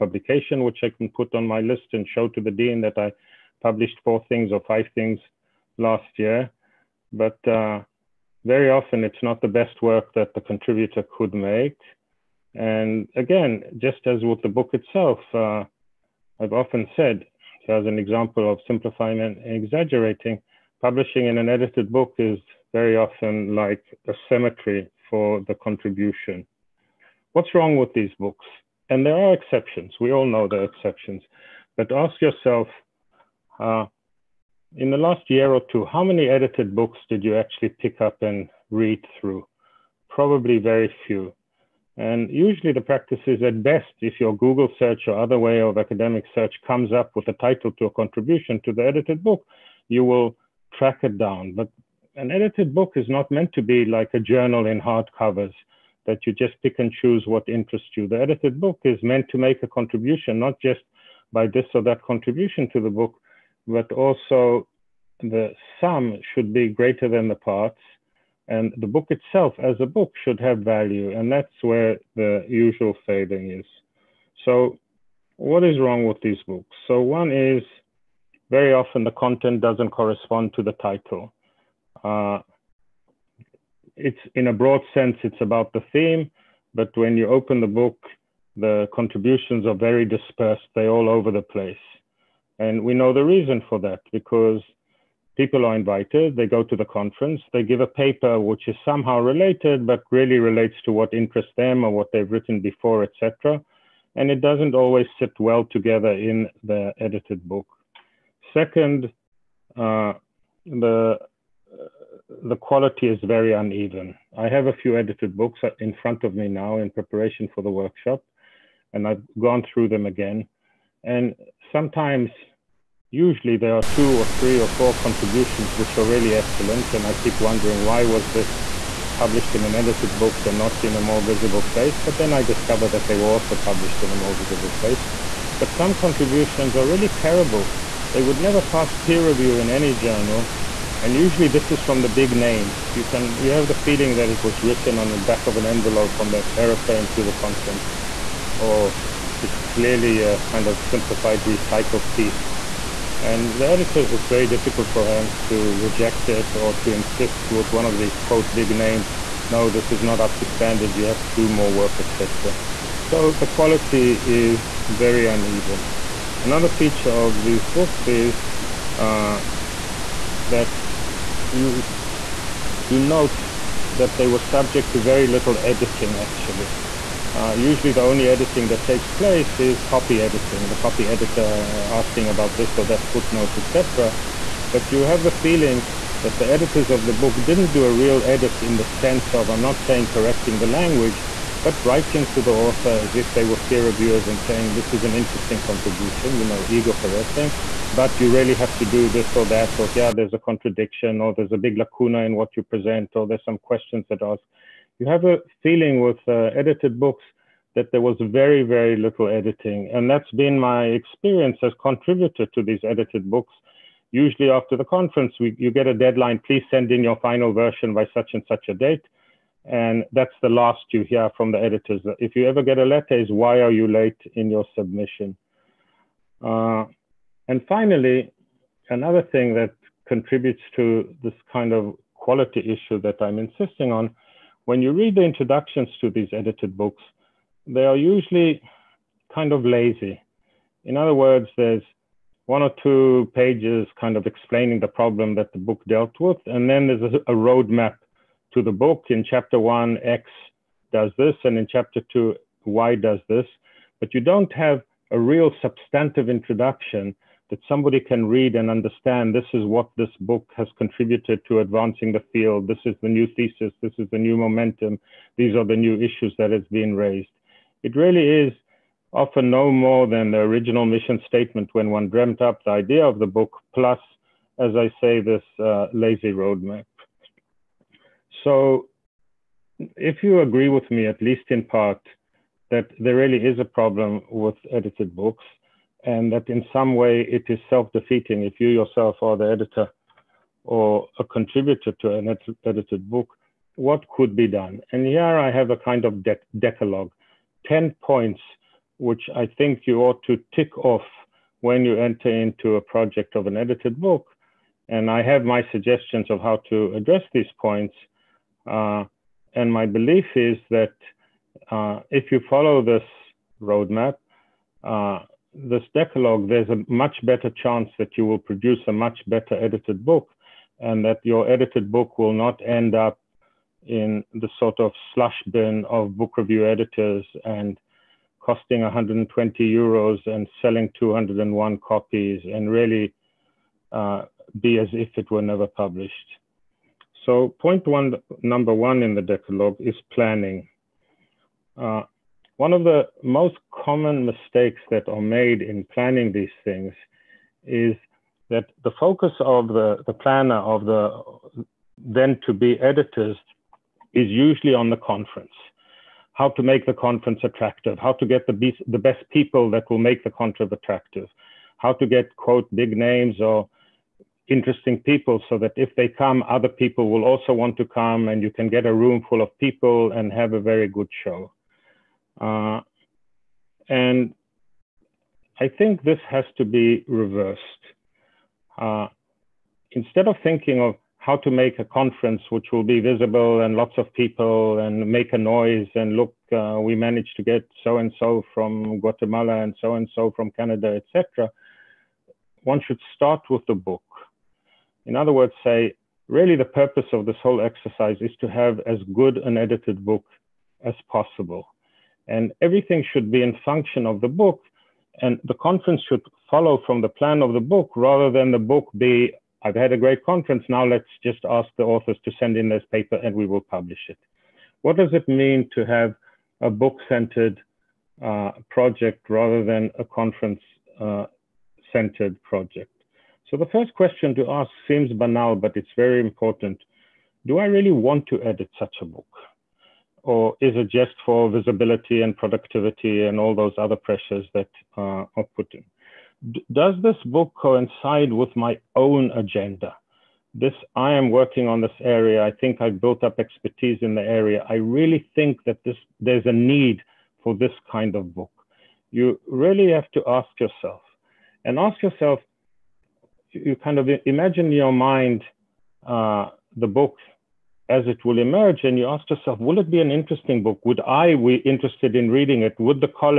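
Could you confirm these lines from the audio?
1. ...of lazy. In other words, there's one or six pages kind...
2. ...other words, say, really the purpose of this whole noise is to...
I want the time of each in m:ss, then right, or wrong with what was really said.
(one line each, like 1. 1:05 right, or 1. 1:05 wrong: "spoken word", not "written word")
1. 3:59 wrong: "two", not "six"
2. 6:35 wrong: "exercise", not "noise".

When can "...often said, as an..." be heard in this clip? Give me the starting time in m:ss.
0:16.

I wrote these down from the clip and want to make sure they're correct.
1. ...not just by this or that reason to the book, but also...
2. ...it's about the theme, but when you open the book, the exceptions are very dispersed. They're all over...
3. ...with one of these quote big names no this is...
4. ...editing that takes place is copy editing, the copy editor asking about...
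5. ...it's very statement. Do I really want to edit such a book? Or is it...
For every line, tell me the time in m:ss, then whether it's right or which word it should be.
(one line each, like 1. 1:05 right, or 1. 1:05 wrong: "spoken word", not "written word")
1. 1:00 wrong: "contribution", not "reason"
2. 1:25 wrong: "contributions", not "exceptions"
3. 2:37 right
4. 2:58 right
5. 7:05 wrong: "important", not "statement".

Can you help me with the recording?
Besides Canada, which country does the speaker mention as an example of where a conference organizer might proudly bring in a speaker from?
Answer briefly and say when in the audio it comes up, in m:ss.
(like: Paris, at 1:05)
Guatemala, at 6:28.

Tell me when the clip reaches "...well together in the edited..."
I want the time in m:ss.
1:45.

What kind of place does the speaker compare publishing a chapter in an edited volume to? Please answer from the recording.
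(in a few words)
A cemetery.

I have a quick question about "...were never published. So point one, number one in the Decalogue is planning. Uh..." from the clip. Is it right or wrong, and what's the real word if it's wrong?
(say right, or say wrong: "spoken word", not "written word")
right.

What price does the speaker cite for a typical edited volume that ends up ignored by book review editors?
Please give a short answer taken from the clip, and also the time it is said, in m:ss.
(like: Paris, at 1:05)
120 euros, at 5:28.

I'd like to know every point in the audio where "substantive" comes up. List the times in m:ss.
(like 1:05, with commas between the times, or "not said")
4:15.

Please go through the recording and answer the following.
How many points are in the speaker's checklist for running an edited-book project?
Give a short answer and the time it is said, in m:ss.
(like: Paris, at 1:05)
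10, at 4:57.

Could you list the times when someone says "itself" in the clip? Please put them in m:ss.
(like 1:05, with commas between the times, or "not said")
0:14, 1:09.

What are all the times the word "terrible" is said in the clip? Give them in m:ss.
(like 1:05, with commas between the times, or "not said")
2:17.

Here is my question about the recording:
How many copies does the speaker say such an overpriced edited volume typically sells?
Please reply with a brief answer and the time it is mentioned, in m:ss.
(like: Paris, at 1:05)
201, at 5:30.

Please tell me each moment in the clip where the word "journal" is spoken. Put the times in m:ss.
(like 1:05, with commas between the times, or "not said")
0:54, 2:19.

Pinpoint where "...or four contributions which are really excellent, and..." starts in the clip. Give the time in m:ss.
2:04.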